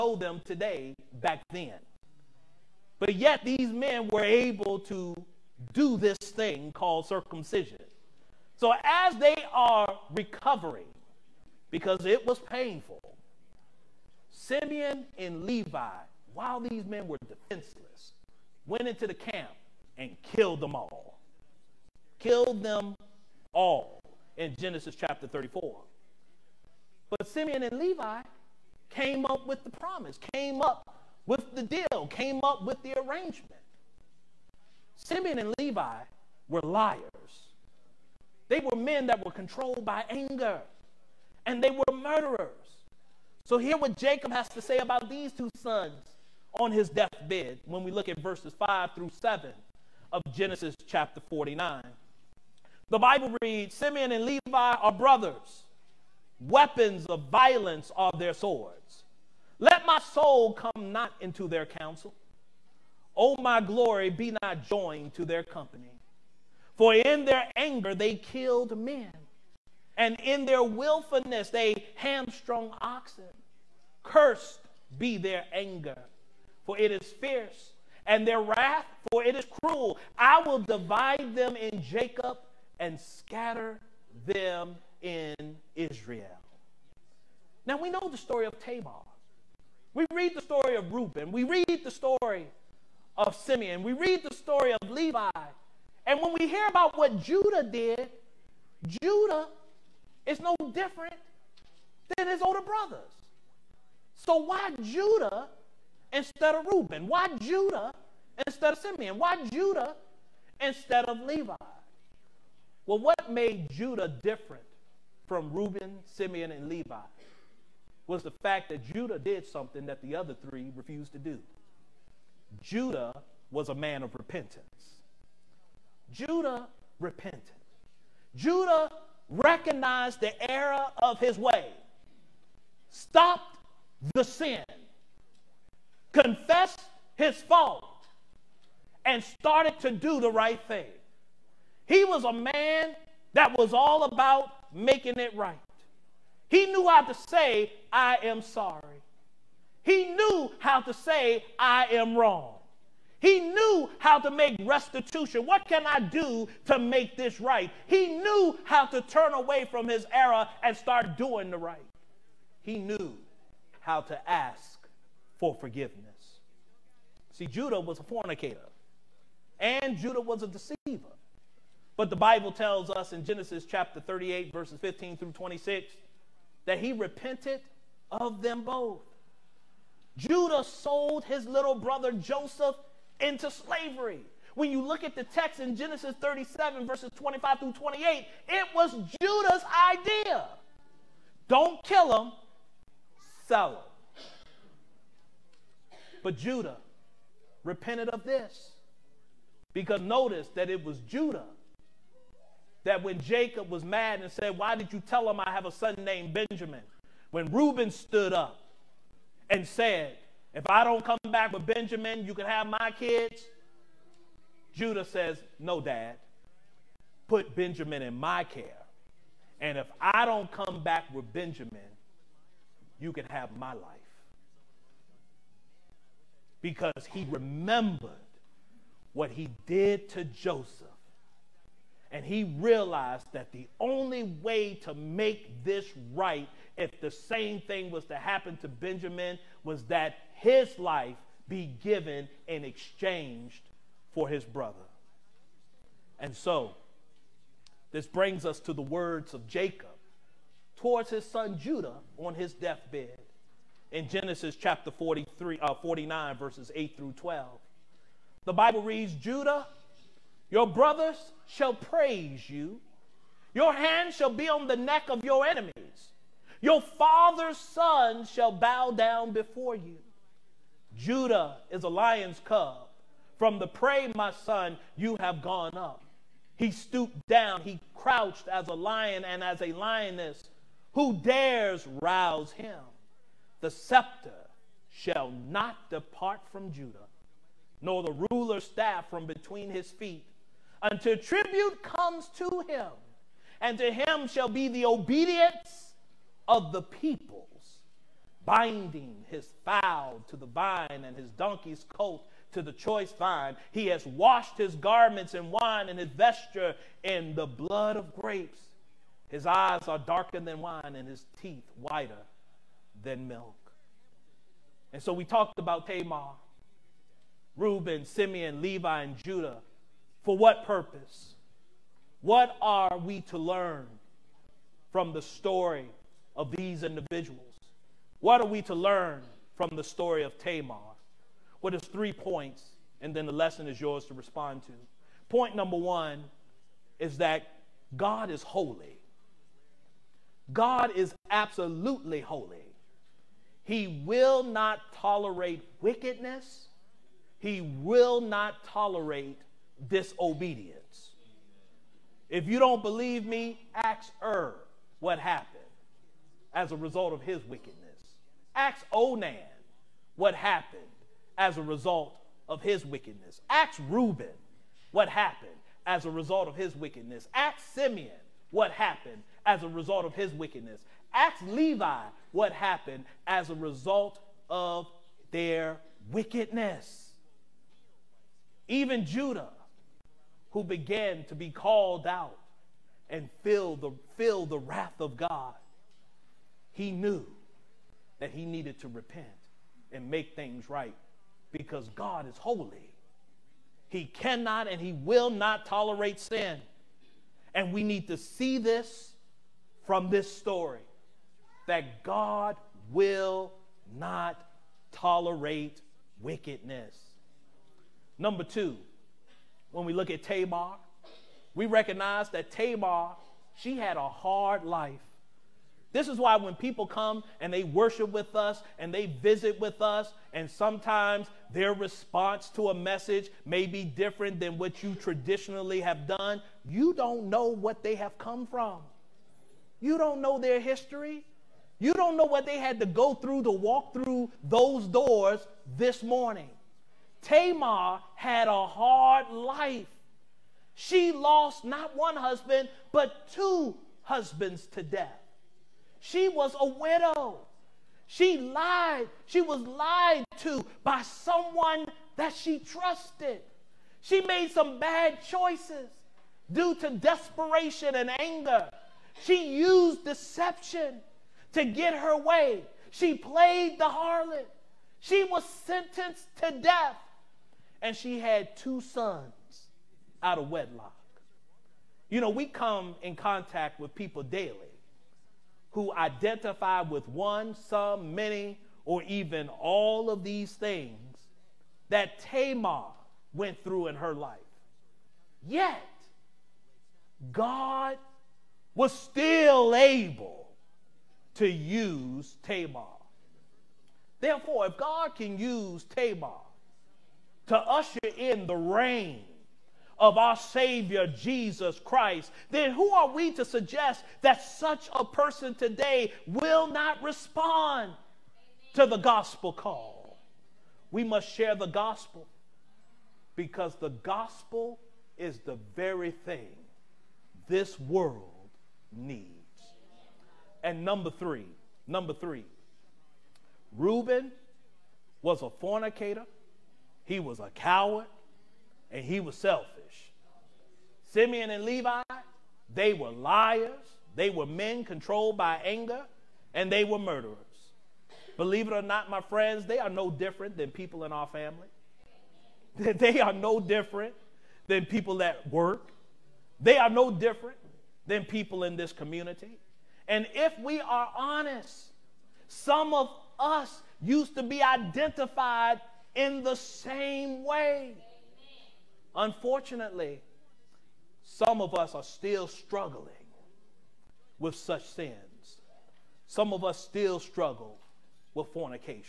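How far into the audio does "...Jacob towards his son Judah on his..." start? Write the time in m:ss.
4:09.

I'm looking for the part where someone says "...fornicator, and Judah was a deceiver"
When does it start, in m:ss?
2:48.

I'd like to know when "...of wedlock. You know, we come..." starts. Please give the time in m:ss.
7:50.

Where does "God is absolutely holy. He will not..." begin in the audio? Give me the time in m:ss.
5:40.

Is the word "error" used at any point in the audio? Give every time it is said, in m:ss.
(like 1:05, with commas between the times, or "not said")
2:10, 2:40.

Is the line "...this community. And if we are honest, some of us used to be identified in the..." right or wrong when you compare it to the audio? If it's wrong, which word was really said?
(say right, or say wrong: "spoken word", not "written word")
right.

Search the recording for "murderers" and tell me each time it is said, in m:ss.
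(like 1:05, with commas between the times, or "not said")
0:41, 8:56.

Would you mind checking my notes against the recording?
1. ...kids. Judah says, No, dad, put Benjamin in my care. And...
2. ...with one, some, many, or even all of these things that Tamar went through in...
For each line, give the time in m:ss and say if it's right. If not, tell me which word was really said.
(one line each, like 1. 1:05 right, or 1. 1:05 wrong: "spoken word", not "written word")
1. 3:32 right
2. 7:56 right.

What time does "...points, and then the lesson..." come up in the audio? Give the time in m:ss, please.
5:32.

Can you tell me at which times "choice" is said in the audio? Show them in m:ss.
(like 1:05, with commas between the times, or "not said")
5:02, 7:35.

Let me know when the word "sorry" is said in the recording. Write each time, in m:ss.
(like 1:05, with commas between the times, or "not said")
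2:28.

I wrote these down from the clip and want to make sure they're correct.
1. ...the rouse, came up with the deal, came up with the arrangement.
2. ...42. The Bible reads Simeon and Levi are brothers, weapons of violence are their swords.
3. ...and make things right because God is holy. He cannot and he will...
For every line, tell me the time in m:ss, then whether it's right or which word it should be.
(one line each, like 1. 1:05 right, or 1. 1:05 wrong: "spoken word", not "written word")
1. 0:29 wrong: "promise", not "rouse"
2. 0:51 wrong: "49", not "42"
3. 6:29 right.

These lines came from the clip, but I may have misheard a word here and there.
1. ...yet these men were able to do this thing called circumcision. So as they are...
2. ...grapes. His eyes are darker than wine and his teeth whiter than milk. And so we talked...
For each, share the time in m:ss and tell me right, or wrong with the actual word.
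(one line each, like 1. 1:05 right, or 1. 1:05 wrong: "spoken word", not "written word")
1. 0:03 right
2. 5:08 right.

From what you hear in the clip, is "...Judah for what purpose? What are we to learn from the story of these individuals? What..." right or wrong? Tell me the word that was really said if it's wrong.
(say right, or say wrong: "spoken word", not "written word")
right.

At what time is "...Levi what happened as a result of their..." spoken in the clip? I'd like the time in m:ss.
6:11.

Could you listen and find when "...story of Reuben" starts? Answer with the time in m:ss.
1:30.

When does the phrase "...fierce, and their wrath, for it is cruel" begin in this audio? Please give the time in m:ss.
1:17.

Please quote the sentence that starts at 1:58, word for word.
was the fact that Judah did something that the other three refused to do.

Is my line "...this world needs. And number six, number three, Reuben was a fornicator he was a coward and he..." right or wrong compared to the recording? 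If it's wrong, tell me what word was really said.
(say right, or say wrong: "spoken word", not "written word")
wrong: "three", not "six".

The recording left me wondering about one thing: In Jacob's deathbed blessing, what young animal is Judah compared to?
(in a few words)
A lion's cub.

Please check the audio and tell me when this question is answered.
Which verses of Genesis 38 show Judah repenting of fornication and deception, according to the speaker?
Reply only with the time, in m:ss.
2:54.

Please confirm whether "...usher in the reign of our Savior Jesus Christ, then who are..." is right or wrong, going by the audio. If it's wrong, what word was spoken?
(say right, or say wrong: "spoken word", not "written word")
right.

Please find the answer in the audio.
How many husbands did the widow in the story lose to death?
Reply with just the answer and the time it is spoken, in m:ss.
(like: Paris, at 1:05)
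2, at 7:23.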